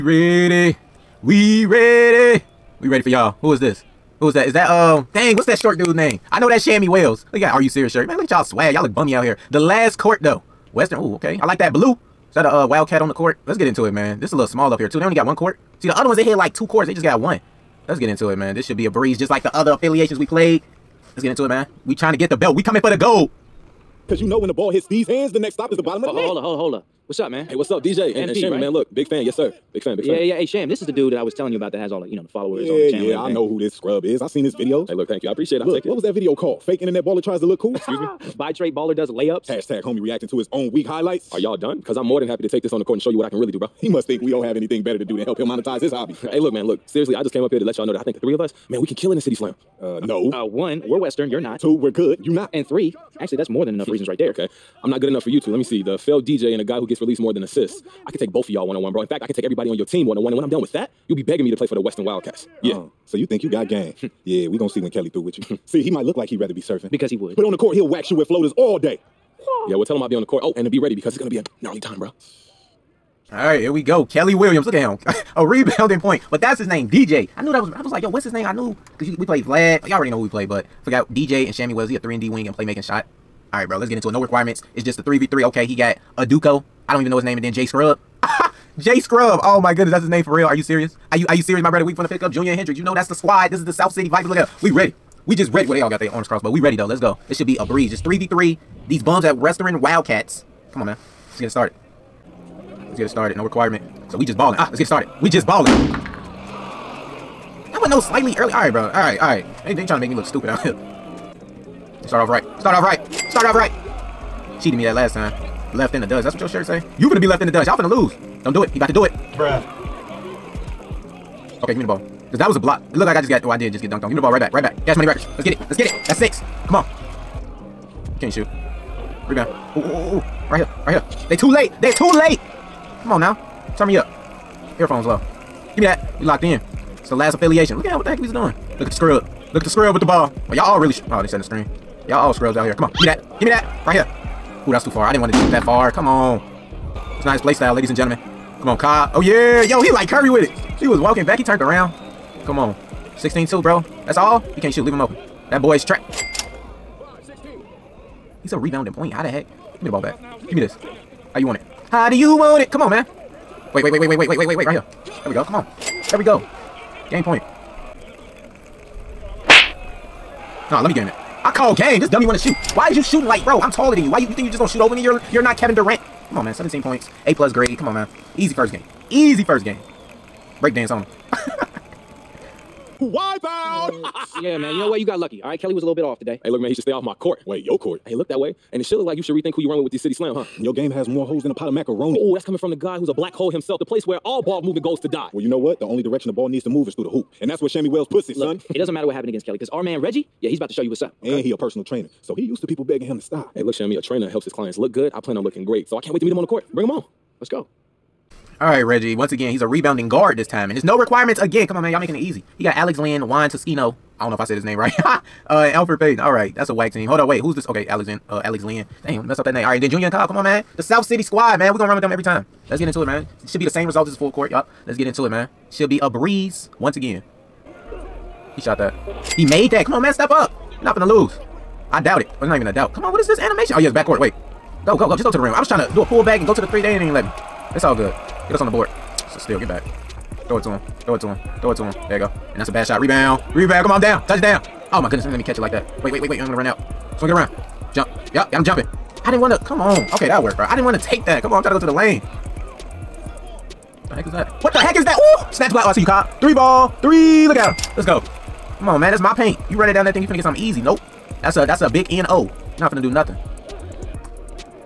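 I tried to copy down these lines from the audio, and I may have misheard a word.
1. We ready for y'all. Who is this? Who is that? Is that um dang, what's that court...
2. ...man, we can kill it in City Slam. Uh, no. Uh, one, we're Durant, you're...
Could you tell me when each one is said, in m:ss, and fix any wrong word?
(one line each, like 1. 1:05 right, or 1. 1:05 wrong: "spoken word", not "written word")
1. 0:02 wrong: "short", not "court"
2. 0:48 wrong: "Western", not "Durant".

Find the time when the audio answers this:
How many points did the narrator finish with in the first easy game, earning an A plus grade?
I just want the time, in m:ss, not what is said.
2:56.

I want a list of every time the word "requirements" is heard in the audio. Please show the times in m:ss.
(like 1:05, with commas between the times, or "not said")
1:24, 1:43, 3:30.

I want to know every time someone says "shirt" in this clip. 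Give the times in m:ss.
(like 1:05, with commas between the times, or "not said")
0:07, 1:56.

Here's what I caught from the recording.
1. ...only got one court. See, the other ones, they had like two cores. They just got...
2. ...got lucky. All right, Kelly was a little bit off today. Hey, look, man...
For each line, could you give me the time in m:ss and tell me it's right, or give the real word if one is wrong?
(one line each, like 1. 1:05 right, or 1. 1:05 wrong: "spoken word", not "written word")
1. 0:15 right
2. 3:05 right.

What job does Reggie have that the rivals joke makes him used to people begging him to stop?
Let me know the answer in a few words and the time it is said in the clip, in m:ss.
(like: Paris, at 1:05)
personal trainer, at 3:21.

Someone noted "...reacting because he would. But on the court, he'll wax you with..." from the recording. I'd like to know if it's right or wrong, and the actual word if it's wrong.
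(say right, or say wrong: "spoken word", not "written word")
wrong: "surfing", not "reacting".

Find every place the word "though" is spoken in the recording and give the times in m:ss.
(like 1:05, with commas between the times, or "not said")
0:10, 1:36.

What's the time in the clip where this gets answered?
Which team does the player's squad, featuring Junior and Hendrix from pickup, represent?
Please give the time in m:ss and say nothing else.
1:33.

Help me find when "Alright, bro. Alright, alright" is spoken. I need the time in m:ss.
1:48.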